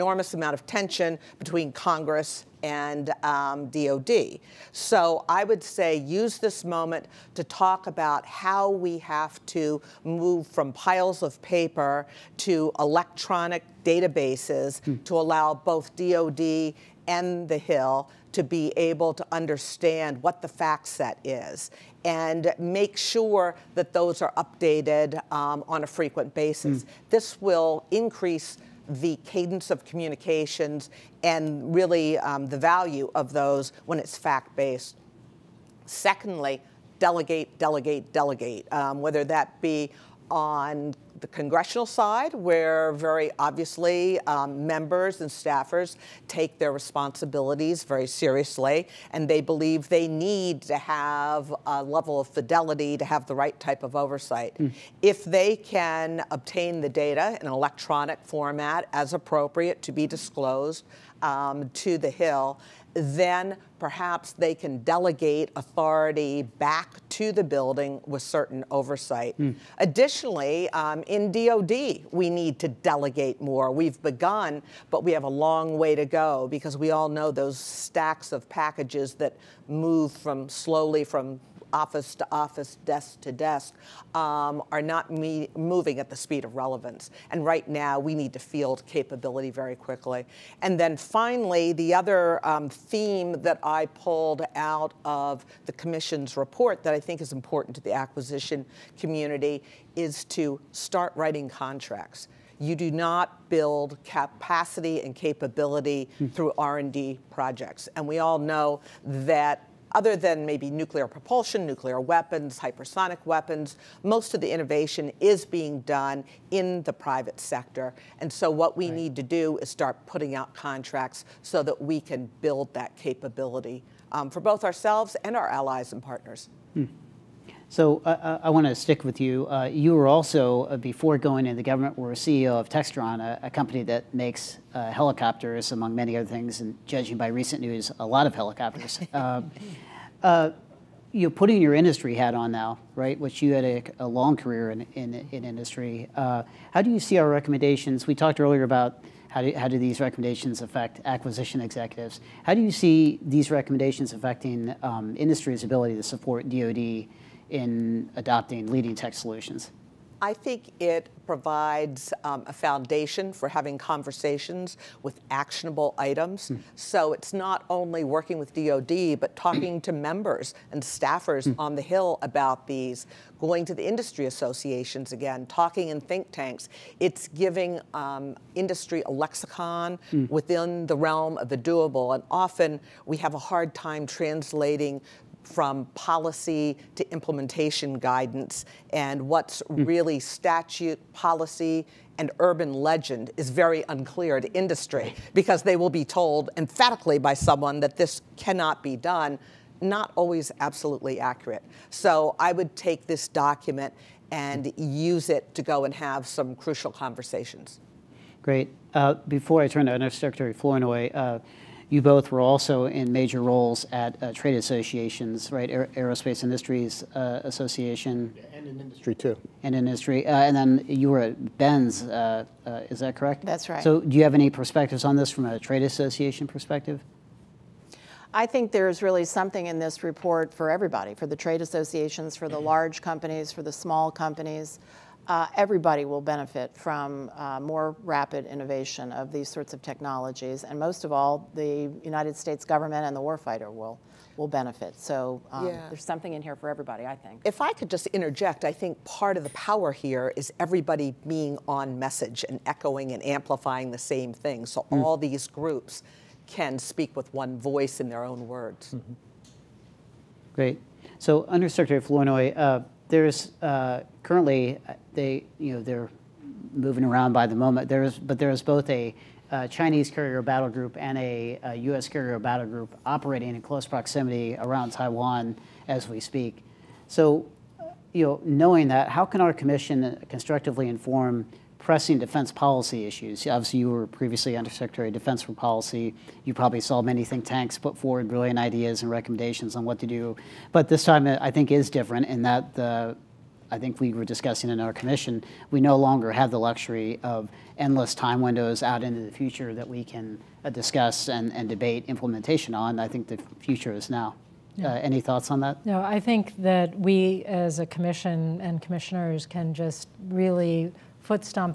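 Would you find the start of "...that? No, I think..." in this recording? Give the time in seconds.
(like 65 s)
305 s.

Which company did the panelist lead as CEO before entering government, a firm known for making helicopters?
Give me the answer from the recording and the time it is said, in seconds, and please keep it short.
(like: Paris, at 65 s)
Textron, at 132 s.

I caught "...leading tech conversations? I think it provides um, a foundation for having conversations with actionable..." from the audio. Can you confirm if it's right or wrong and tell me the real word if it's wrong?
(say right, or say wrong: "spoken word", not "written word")
wrong: "solutions", not "conversations".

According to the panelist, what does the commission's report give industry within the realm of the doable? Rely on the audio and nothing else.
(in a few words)
A lexicon.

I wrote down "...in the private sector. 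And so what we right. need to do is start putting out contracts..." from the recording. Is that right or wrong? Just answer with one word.
right.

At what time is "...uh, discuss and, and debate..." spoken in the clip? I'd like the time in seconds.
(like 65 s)
300 s.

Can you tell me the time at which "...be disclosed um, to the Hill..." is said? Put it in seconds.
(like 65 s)
59 s.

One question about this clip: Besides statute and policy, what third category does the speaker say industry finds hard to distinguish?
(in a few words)
Urban legend.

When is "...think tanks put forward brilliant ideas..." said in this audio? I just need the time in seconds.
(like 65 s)
287 s.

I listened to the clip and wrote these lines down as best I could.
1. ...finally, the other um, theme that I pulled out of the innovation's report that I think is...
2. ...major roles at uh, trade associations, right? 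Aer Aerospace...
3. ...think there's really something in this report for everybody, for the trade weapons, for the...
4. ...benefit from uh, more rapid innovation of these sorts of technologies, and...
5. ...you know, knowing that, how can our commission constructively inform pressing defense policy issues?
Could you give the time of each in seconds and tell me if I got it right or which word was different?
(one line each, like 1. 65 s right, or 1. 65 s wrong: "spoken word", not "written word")
1. 90 s wrong: "commission", not "innovation"
2. 213 s right
3. 228 s wrong: "associations", not "weapons"
4. 236 s right
5. 278 s right.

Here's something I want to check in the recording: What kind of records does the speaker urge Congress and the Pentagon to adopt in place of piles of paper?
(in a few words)
Electronic databases.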